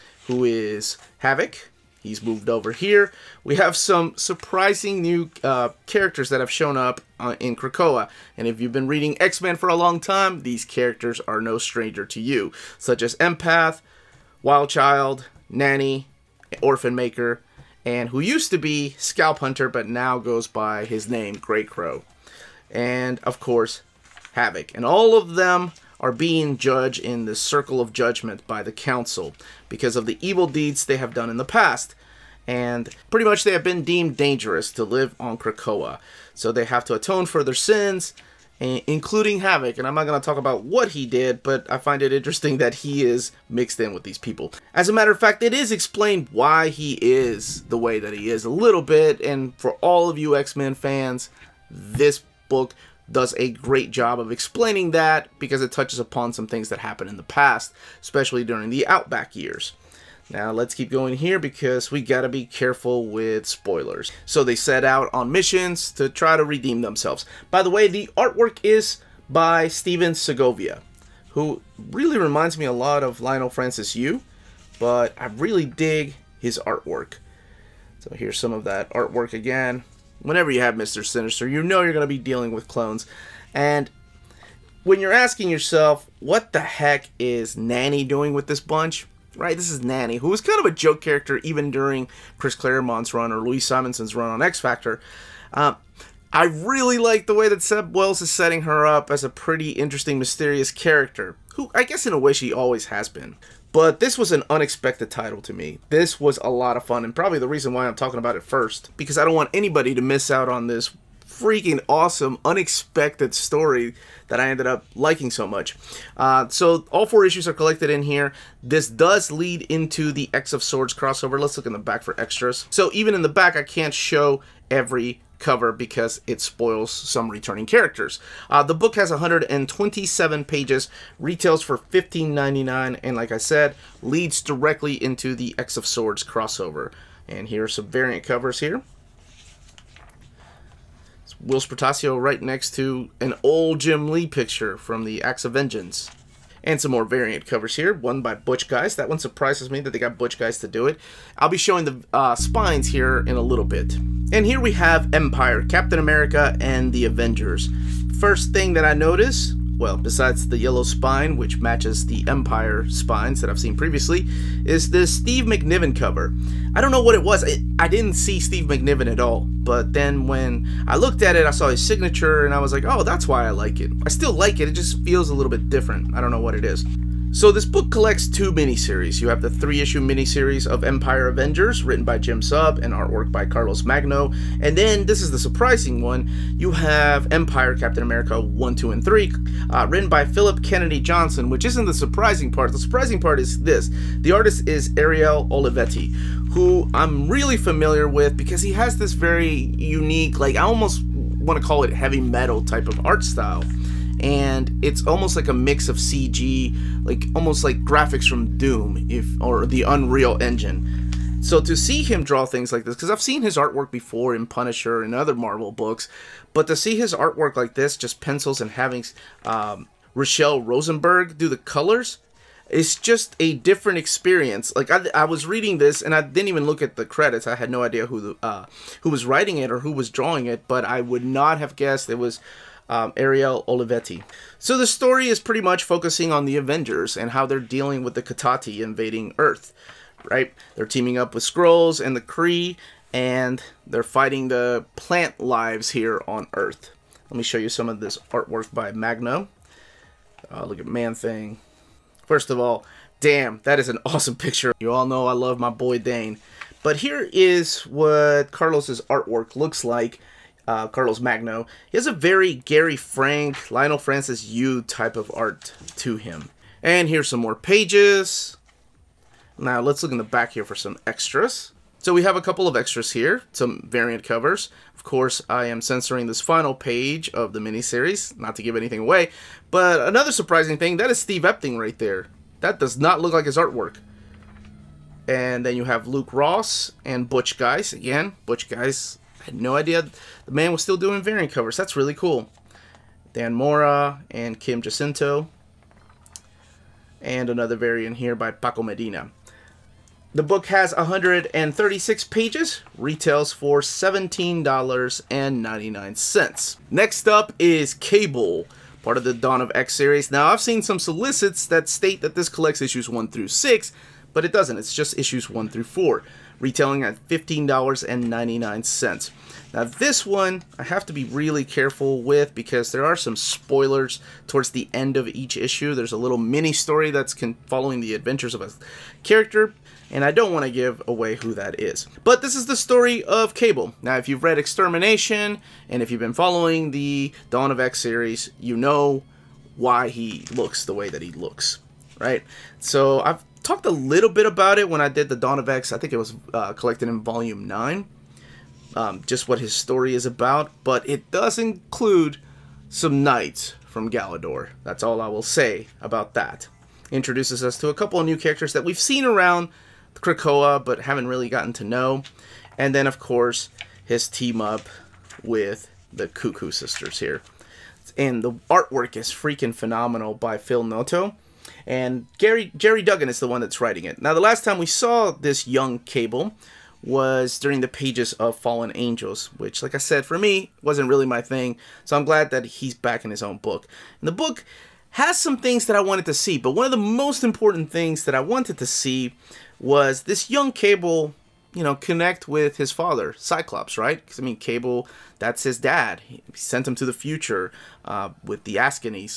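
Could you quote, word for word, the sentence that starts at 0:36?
So they have to atone for their sins, including Havoc.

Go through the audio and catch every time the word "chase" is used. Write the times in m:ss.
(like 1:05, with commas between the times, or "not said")
not said.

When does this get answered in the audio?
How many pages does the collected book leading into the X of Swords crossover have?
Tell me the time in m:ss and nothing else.
2:09.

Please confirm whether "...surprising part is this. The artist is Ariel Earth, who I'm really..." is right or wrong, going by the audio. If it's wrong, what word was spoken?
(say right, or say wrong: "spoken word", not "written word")
wrong: "Olivetti", not "Earth".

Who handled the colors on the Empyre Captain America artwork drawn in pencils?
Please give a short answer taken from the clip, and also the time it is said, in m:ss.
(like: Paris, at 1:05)
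Rachelle Rosenberg, at 3:40.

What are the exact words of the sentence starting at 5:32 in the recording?
But this is the story of Cable.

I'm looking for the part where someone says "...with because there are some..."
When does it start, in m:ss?
5:22.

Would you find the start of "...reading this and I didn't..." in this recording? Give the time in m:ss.
3:45.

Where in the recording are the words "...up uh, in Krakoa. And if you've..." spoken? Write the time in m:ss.
0:06.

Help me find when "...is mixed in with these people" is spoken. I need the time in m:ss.
0:43.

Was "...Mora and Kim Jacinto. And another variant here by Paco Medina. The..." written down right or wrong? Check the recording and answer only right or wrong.
right.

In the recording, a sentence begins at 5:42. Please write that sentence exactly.
So I've talked a little bit about it when I did the Dawn of X.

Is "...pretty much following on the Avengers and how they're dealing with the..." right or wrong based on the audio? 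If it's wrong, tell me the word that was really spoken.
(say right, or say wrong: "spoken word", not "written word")
wrong: "focusing", not "following".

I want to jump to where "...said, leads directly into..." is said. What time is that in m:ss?
2:13.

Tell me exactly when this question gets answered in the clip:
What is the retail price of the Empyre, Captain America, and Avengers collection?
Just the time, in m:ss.
5:03.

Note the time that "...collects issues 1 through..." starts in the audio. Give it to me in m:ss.
5:12.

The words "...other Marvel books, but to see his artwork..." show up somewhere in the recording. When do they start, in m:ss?
3:35.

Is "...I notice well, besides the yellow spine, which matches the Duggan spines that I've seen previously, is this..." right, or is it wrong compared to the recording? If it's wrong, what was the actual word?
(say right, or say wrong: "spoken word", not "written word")
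wrong: "Empyre", not "Duggan".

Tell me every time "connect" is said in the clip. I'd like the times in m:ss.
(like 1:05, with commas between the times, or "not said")
6:31.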